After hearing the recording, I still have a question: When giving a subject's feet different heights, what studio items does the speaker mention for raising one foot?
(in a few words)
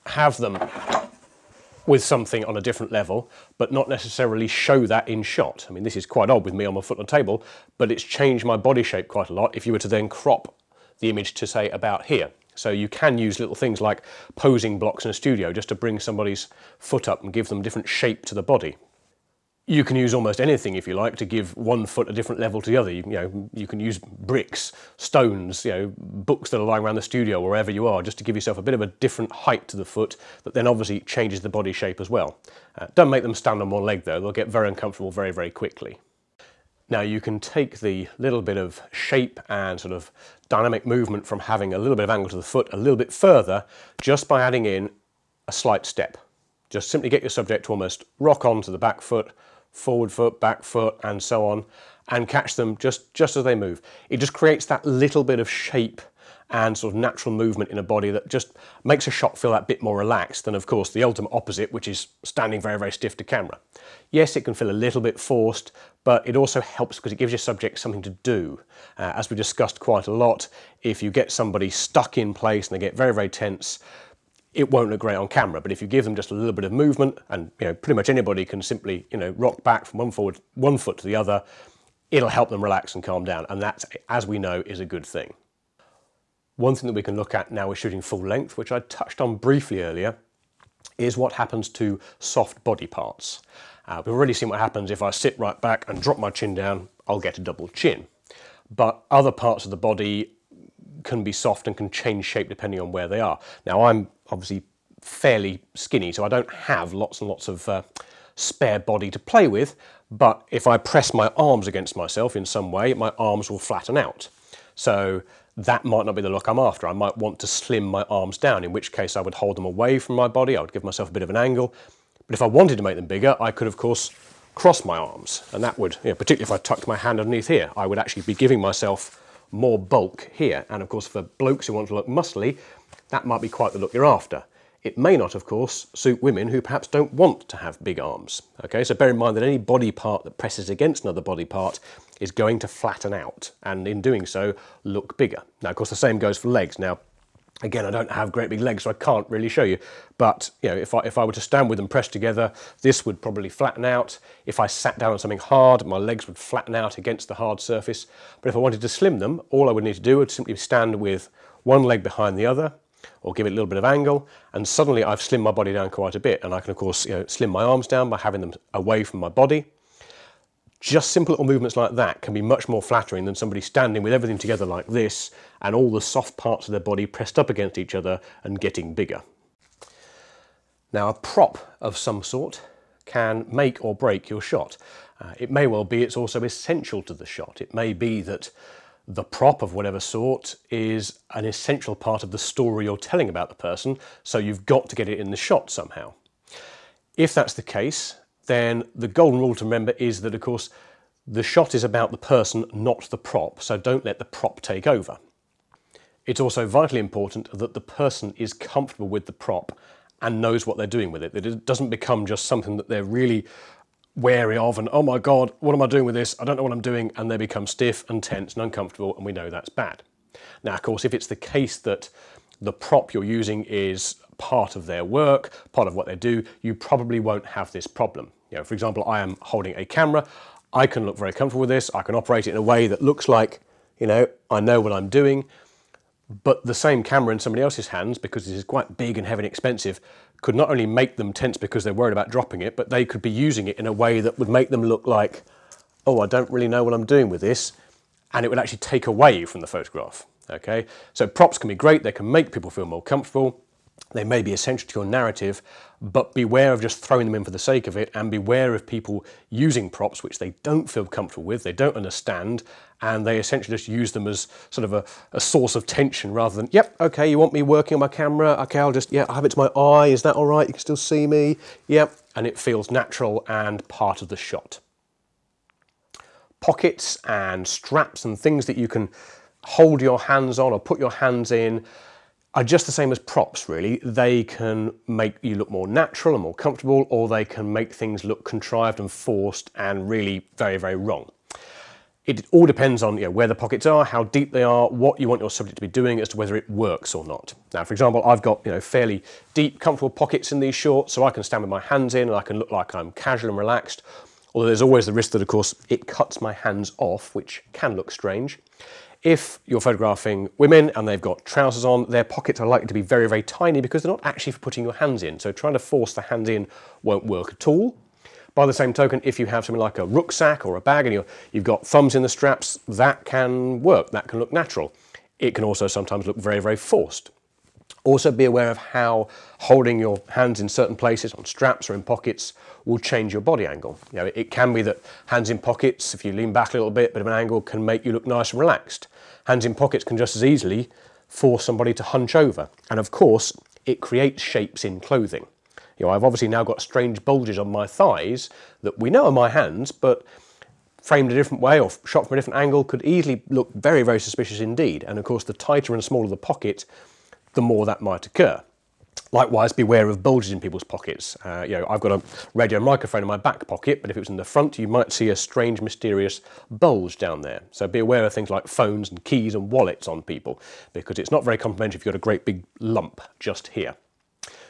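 posing blocks.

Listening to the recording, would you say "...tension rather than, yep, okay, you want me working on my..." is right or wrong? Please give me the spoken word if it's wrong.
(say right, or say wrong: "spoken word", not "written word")
right.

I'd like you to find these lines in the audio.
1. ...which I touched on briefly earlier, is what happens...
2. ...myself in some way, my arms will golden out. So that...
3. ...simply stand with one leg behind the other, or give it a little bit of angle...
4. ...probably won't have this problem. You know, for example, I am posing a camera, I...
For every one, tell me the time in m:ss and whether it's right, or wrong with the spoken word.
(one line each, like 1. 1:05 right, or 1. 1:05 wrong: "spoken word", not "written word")
1. 1:28 right
2. 1:51 wrong: "flatten", not "golden"
3. 2:40 right
4. 3:46 wrong: "holding", not "posing".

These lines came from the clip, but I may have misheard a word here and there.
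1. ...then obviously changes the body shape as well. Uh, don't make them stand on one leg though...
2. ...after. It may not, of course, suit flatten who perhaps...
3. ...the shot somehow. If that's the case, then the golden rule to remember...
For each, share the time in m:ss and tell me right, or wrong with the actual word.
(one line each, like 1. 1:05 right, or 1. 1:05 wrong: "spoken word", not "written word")
1. 0:30 right
2. 2:14 wrong: "women", not "flatten"
3. 3:15 right.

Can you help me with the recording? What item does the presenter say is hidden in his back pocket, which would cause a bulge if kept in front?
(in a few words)
radio microphone.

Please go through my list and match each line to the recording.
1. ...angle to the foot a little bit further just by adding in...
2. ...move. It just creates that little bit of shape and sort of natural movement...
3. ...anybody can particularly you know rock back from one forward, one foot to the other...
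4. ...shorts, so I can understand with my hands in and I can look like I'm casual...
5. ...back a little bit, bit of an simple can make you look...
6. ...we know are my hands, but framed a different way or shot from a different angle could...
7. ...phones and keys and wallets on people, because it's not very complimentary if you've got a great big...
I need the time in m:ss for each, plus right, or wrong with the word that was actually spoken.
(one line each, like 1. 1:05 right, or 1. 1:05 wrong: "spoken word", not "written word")
1. 0:42 right
2. 0:53 right
3. 1:18 wrong: "simply", not "particularly"
4. 5:00 wrong: "stand", not "understand"
5. 5:36 wrong: "angle", not "simple"
6. 5:48 right
7. 6:08 right.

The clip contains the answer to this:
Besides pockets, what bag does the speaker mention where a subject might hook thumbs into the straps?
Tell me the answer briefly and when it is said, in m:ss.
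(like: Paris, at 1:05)
rucksack, at 5:20.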